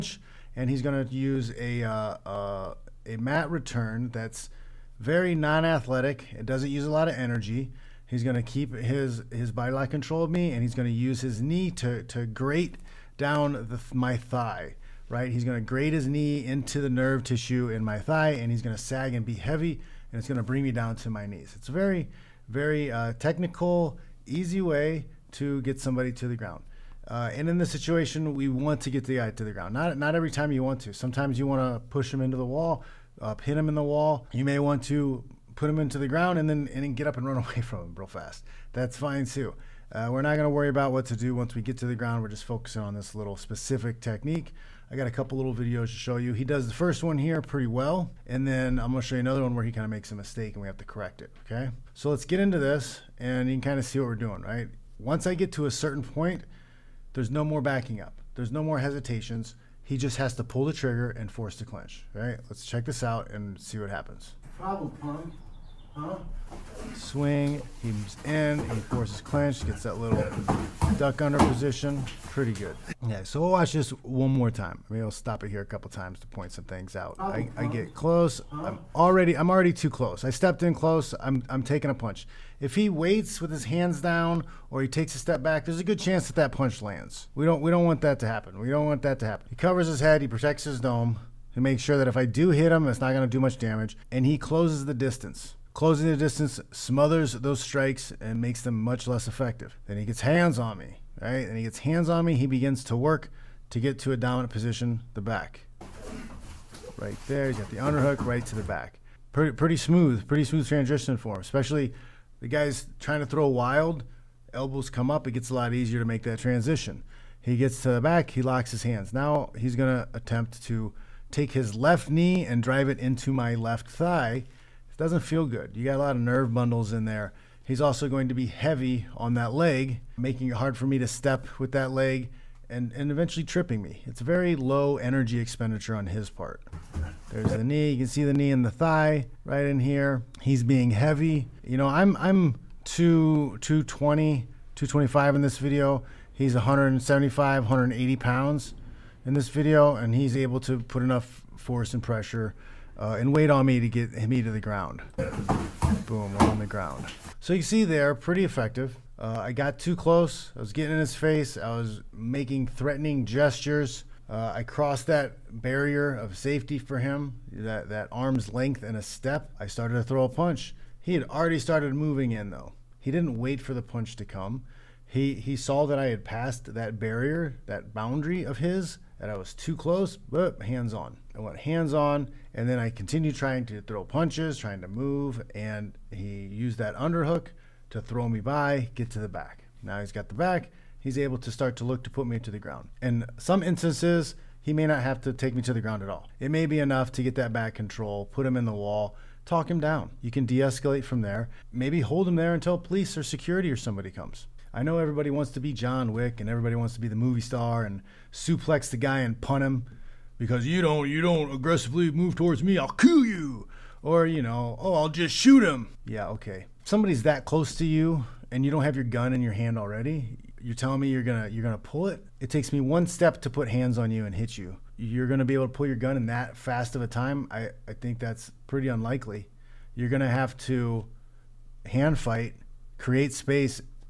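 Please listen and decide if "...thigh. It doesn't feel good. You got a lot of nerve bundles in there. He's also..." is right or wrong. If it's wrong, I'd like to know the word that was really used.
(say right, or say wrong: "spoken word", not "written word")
right.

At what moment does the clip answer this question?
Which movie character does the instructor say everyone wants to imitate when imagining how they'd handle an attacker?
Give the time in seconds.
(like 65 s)
205 s.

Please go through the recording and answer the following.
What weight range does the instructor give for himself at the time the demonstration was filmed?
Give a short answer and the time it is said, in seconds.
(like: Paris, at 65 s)
220-225 pounds, at 142 s.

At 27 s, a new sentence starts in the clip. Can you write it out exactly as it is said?
Uh, and in this situation, we want to get the guy to the ground.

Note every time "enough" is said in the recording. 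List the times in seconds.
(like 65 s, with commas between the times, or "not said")
151 s, 196 s.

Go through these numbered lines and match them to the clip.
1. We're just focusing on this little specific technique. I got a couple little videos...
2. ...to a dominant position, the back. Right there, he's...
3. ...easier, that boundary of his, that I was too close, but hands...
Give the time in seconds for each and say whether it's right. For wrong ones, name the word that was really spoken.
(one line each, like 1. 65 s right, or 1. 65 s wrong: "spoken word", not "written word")
1. 42 s right
2. 103 s right
3. 176 s wrong: "barrier", not "easier".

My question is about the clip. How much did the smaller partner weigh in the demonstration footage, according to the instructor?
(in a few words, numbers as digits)
175-180 pounds.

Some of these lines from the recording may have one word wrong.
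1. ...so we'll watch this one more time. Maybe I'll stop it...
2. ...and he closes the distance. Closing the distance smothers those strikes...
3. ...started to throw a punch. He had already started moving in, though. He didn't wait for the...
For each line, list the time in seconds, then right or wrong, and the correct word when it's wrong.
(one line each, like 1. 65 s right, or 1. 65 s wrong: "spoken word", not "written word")
1. 73 s right
2. 94 s right
3. 169 s right.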